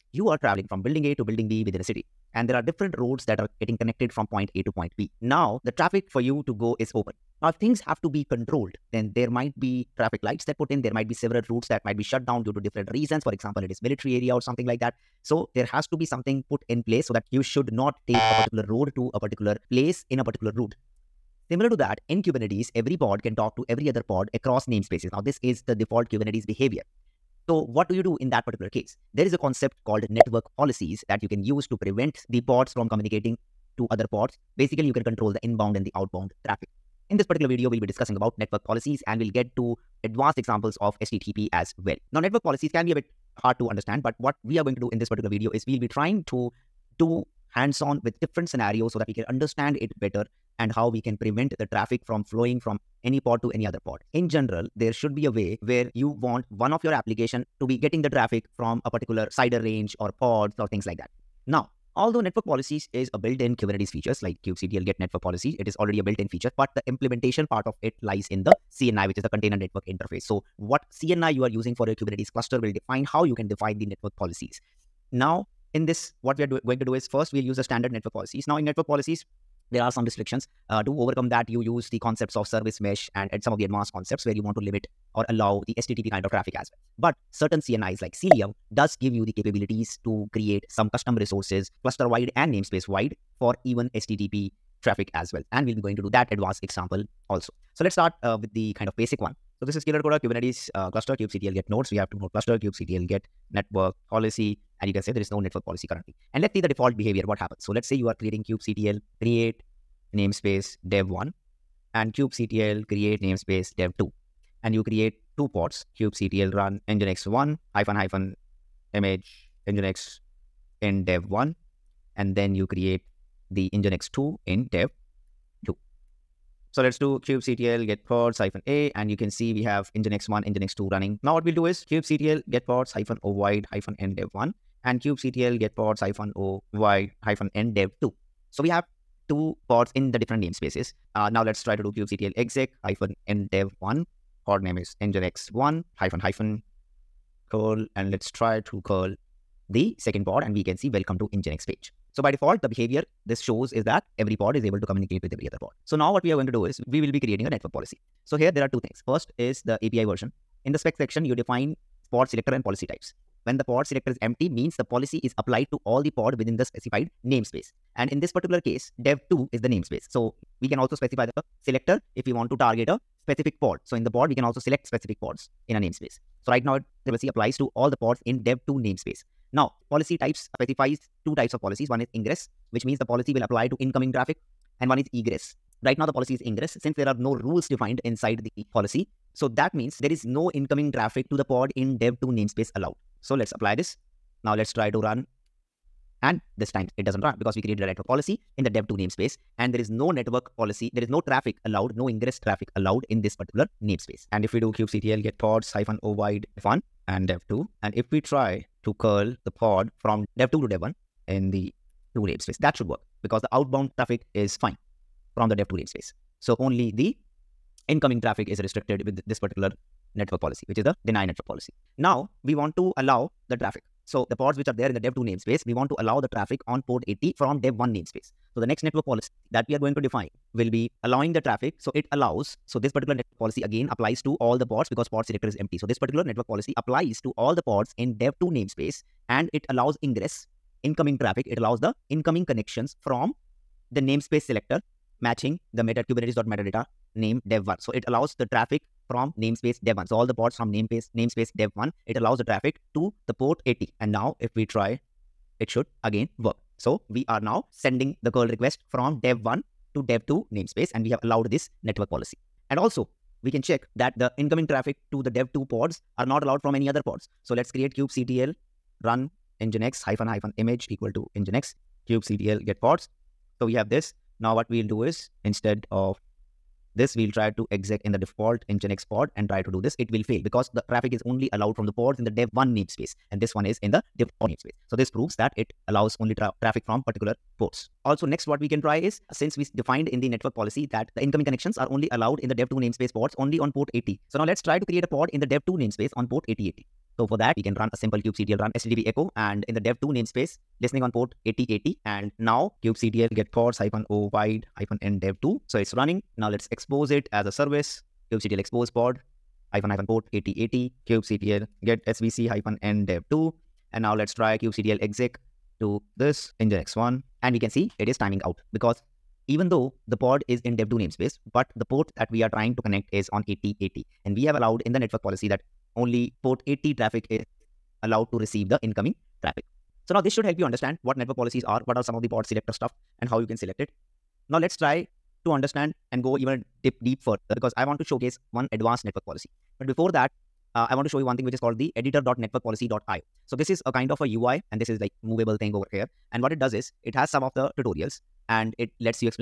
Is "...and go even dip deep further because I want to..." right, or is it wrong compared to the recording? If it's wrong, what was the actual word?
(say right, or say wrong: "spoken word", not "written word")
right.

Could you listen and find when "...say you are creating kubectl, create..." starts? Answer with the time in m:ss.
1:47.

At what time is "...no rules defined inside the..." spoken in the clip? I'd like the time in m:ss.
3:07.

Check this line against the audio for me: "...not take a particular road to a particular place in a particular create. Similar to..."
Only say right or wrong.
wrong.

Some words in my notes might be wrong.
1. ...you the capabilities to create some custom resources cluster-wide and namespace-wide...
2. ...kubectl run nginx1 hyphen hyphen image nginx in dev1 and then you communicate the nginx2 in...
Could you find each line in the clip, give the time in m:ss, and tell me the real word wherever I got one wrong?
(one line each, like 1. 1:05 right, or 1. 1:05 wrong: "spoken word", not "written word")
1. 1:29 right
2. 1:55 wrong: "create", not "communicate".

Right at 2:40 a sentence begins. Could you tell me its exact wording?
In the spec section, you define pod selector and policy types.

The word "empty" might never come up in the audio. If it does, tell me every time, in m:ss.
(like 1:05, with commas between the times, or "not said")
2:44, 3:55.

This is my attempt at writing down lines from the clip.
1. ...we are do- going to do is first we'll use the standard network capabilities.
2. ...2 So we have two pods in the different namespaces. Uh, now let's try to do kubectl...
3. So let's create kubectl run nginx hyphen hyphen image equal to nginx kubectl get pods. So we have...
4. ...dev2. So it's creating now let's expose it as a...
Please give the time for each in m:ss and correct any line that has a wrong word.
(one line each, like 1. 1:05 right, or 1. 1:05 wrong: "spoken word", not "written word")
1. 1:16 wrong: "policies", not "capabilities"
2. 2:18 right
3. 4:27 right
4. 5:05 wrong: "running", not "creating".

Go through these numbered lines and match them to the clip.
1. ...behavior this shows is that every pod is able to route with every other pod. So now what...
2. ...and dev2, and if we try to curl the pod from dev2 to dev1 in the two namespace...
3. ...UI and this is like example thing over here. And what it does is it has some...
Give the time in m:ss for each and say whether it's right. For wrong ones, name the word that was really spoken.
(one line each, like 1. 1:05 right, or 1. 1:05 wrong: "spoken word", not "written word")
1. 2:32 wrong: "communicate", not "route"
2. 3:27 right
3. 5:44 wrong: "movable", not "example".